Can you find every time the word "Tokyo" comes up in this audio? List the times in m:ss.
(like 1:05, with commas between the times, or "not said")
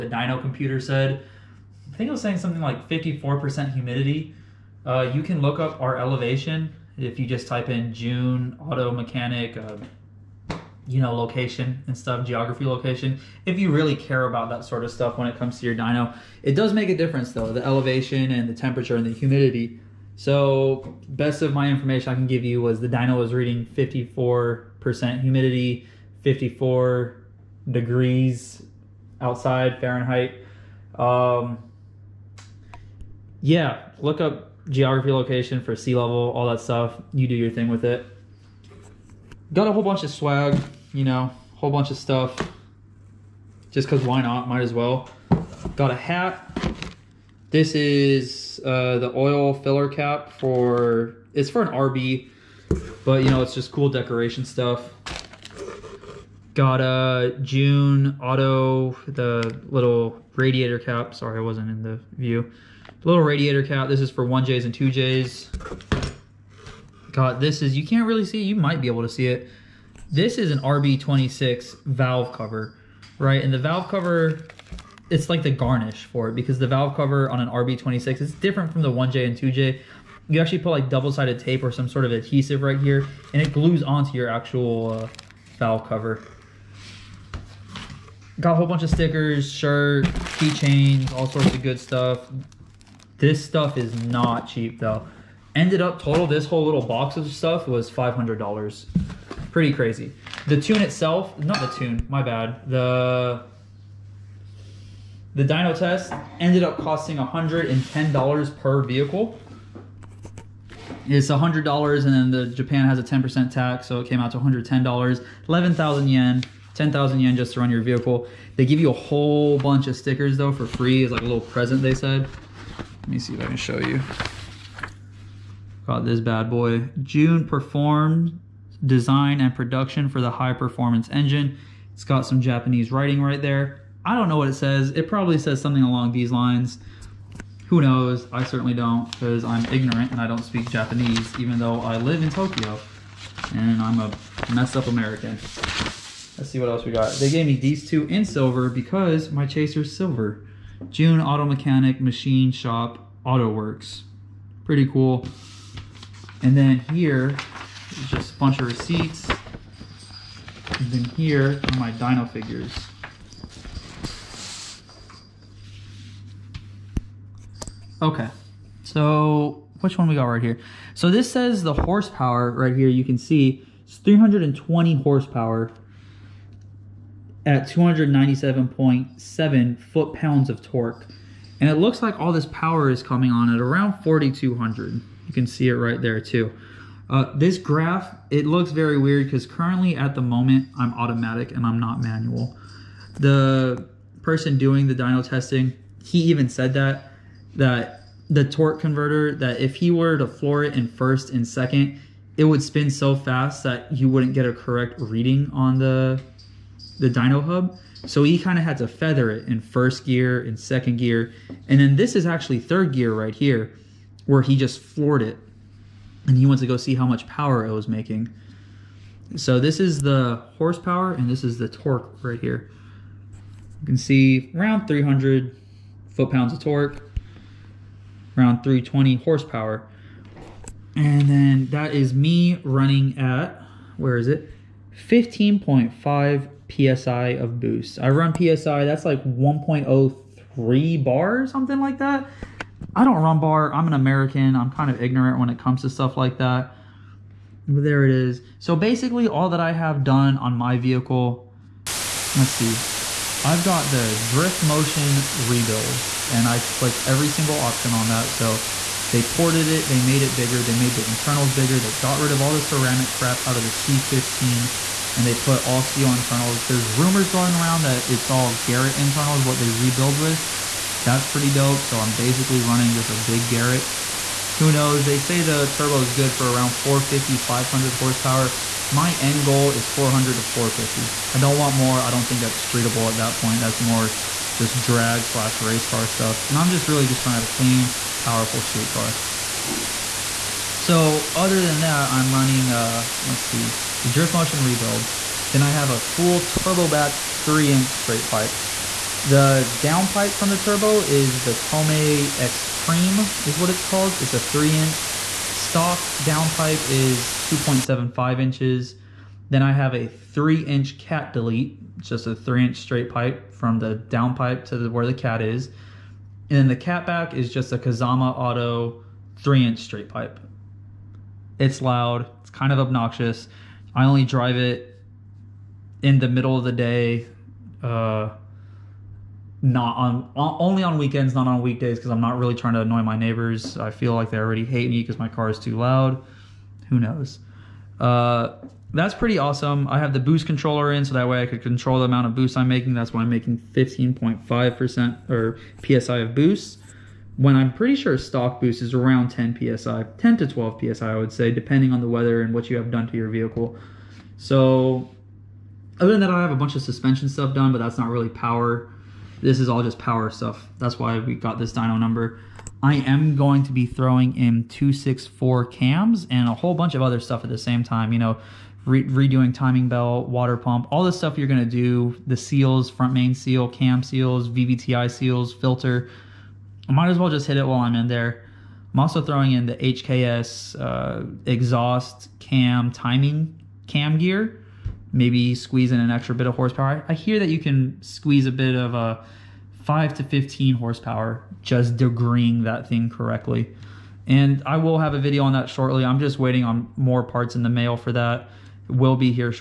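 2:22.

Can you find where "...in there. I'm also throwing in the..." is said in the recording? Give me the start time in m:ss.
6:17.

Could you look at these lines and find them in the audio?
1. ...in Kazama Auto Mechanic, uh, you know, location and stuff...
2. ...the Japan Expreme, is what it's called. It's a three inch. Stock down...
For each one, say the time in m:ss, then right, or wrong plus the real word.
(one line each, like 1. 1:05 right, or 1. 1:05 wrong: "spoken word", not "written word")
1. 0:07 wrong: "JUN", not "Kazama"
2. 5:01 wrong: "Tomei", not "Japan".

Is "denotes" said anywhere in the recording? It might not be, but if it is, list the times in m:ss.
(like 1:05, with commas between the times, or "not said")
not said.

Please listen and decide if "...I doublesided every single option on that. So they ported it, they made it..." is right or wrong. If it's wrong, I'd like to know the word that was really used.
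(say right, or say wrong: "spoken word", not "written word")
wrong: "clicked", not "doublesided".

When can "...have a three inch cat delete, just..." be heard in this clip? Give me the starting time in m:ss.
5:09.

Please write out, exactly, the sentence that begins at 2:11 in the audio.
It's got some Japanese writing right there.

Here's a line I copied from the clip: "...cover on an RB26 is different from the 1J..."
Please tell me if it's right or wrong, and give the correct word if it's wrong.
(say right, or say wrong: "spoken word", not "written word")
right.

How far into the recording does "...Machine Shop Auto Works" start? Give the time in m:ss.
2:31.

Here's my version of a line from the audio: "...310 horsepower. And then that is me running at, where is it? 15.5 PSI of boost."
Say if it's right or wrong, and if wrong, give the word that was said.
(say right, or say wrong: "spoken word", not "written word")
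wrong: "320", not "310".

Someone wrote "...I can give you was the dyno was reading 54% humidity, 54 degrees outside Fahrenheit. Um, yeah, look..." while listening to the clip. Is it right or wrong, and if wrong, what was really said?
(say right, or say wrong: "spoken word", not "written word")
right.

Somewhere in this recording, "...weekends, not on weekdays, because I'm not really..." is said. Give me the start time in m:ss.
5:30.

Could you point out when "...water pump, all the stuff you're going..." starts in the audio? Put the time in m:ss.
6:10.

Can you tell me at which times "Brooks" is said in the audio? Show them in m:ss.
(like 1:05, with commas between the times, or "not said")
not said.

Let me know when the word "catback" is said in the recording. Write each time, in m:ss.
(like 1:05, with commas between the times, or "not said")
5:16.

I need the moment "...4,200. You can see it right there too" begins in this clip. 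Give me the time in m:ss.
3:04.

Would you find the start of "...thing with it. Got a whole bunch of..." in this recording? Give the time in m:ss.
0:37.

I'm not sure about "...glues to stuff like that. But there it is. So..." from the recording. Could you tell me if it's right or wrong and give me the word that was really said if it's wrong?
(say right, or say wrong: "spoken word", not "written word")
wrong: "comes", not "glues".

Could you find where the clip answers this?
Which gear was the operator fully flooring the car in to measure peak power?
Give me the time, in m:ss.
3:32.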